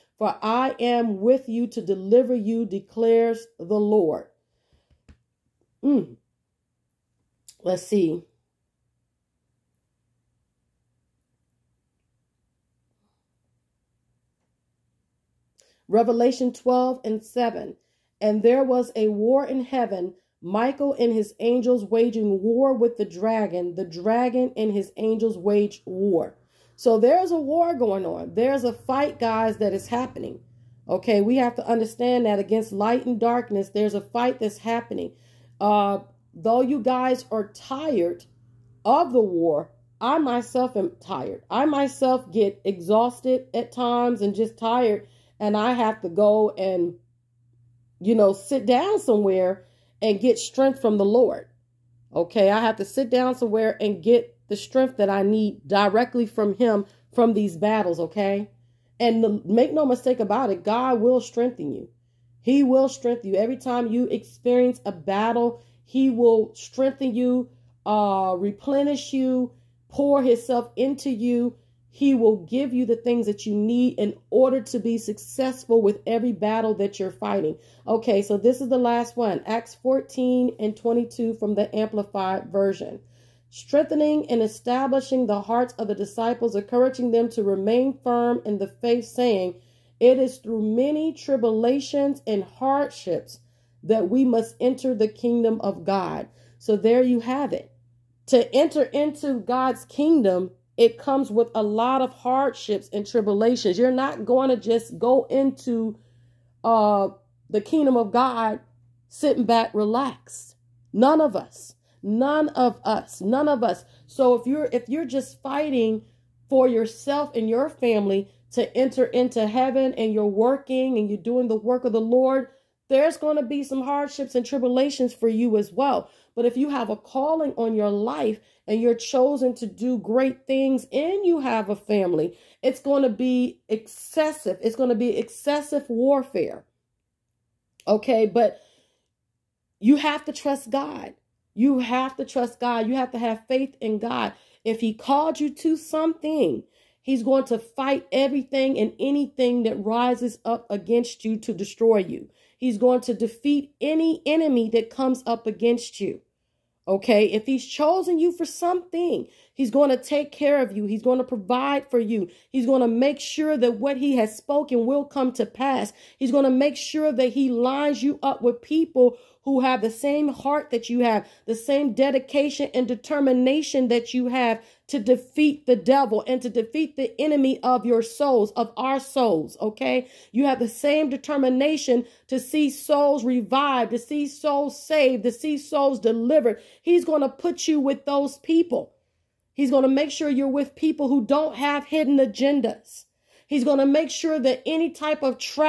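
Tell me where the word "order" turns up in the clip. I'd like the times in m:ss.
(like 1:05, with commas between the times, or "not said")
1:14.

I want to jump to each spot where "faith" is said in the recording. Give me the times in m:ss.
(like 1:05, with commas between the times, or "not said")
1:28, 2:23.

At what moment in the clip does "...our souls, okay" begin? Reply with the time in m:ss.
2:58.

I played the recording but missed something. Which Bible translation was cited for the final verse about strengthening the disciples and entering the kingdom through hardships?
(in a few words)
Amplified Version.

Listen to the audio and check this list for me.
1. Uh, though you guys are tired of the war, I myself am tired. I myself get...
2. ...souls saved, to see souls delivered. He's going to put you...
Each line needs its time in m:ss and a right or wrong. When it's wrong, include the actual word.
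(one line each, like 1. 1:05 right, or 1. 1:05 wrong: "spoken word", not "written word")
1. 0:35 right
2. 3:04 right.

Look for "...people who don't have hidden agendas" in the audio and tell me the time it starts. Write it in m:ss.
3:10.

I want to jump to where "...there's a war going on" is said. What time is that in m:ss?
0:26.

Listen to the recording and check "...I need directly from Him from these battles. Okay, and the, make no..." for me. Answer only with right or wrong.
right.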